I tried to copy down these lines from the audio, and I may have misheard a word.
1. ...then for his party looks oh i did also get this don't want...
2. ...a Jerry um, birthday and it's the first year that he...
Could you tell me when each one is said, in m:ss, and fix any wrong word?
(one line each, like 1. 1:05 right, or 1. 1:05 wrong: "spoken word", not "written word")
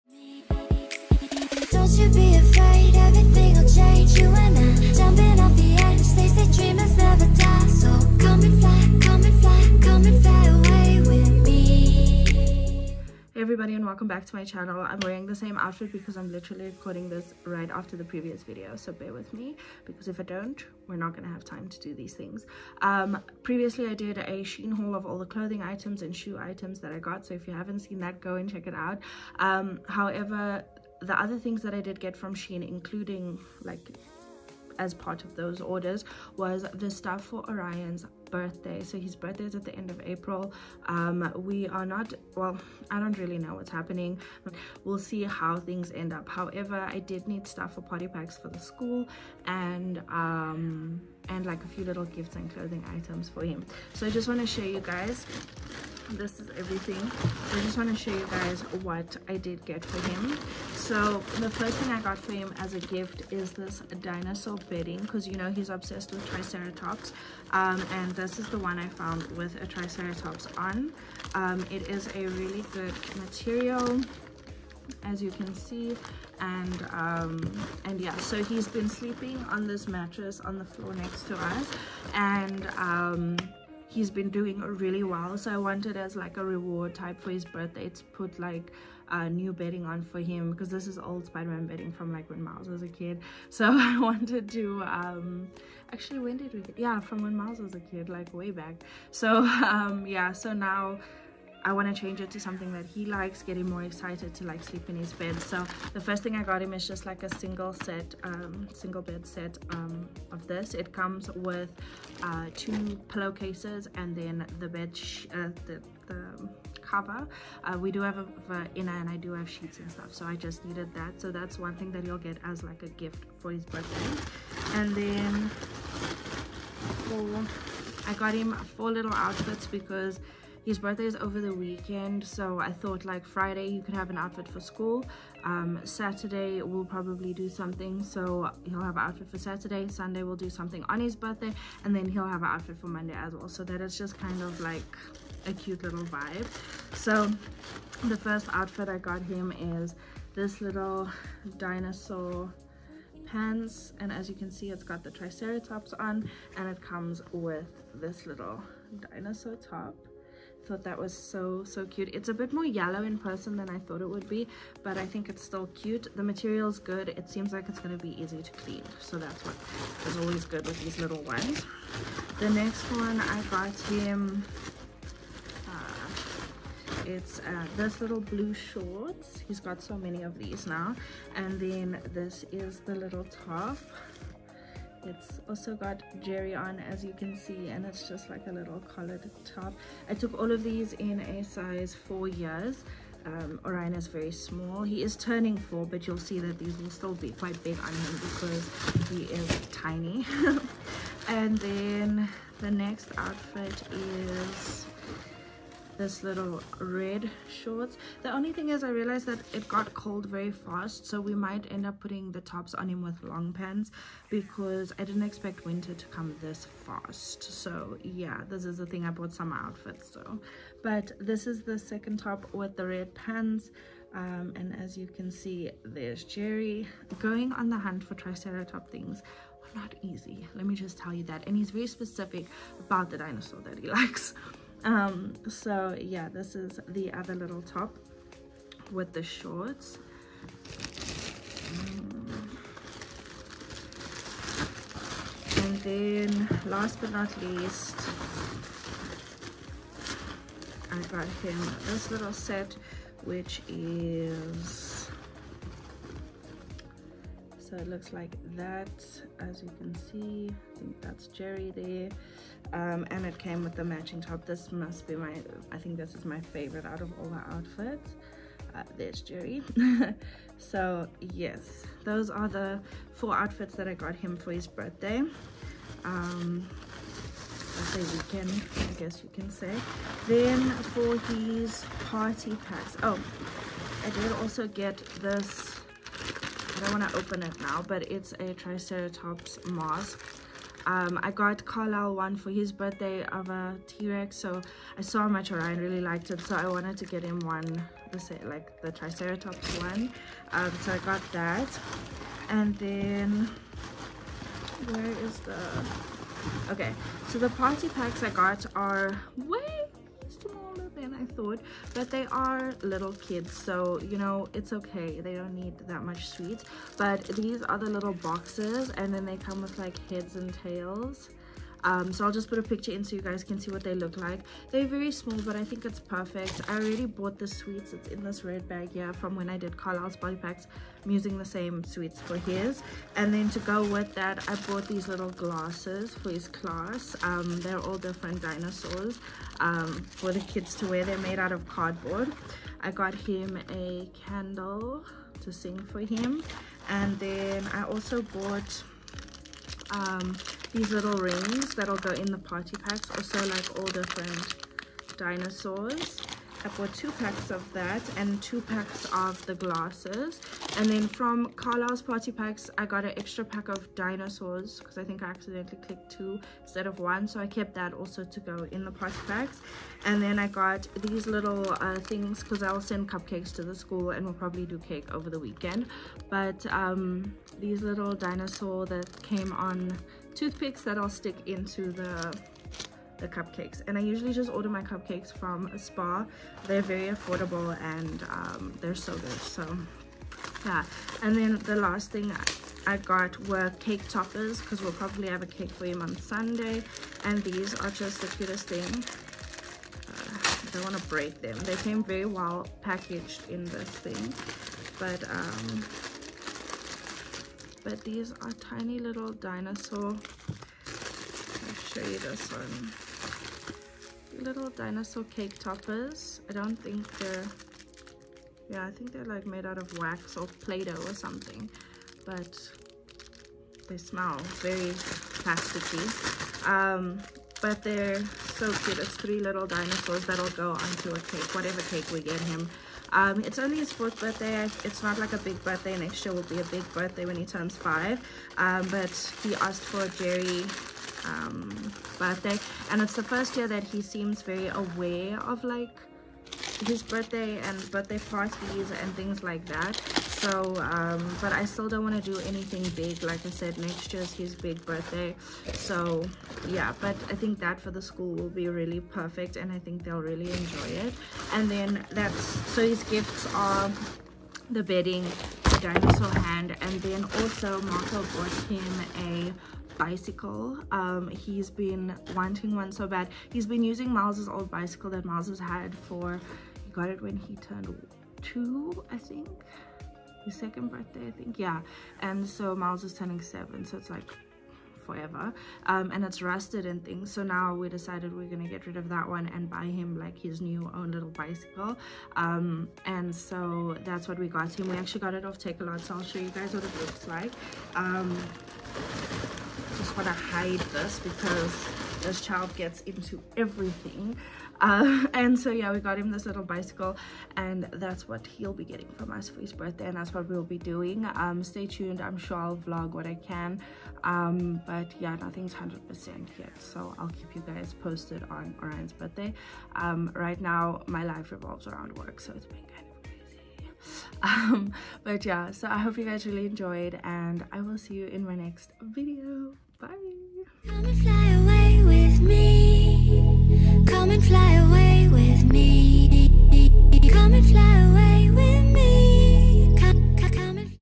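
1. 4:40 wrong: "packs", not "looks"
2. 7:20 right.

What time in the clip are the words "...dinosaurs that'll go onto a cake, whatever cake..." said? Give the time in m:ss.
7:09.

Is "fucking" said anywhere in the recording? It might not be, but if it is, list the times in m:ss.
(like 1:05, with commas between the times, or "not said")
not said.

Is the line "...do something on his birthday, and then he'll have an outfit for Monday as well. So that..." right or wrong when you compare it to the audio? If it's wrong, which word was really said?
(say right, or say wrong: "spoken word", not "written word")
right.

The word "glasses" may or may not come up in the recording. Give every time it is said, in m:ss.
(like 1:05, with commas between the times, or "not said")
5:35, 5:59.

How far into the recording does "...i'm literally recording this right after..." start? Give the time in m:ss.
0:16.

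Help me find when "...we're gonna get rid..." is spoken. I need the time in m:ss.
8:08.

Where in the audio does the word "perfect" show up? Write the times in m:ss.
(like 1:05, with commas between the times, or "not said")
5:25, 7:38.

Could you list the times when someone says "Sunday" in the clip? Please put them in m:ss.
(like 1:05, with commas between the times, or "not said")
2:19, 6:36.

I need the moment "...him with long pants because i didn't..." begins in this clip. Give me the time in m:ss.
3:32.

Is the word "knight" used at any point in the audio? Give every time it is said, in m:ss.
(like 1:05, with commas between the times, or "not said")
not said.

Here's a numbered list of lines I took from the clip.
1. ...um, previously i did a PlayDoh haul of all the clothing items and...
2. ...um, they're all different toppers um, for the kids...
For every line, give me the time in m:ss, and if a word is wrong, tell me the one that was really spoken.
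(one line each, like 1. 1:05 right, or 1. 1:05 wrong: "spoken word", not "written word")
1. 0:22 wrong: "Shein", not "PlayDoh"
2. 5:37 wrong: "dinosaurs", not "toppers".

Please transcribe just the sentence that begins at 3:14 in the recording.
He is turning four, but you'll see that these will still be quite big on him because he is tiny.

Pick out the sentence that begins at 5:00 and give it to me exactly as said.
Um, so I got that, and then where is the?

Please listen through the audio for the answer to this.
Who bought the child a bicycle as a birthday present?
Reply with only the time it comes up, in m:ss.
7:47.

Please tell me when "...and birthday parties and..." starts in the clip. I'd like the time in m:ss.
7:27.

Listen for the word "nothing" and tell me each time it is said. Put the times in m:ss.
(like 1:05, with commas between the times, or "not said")
8:35.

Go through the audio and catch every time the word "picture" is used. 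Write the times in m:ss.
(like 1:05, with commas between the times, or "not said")
5:22.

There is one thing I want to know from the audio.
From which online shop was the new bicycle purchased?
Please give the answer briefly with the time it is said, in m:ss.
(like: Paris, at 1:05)
Takealot, at 8:15.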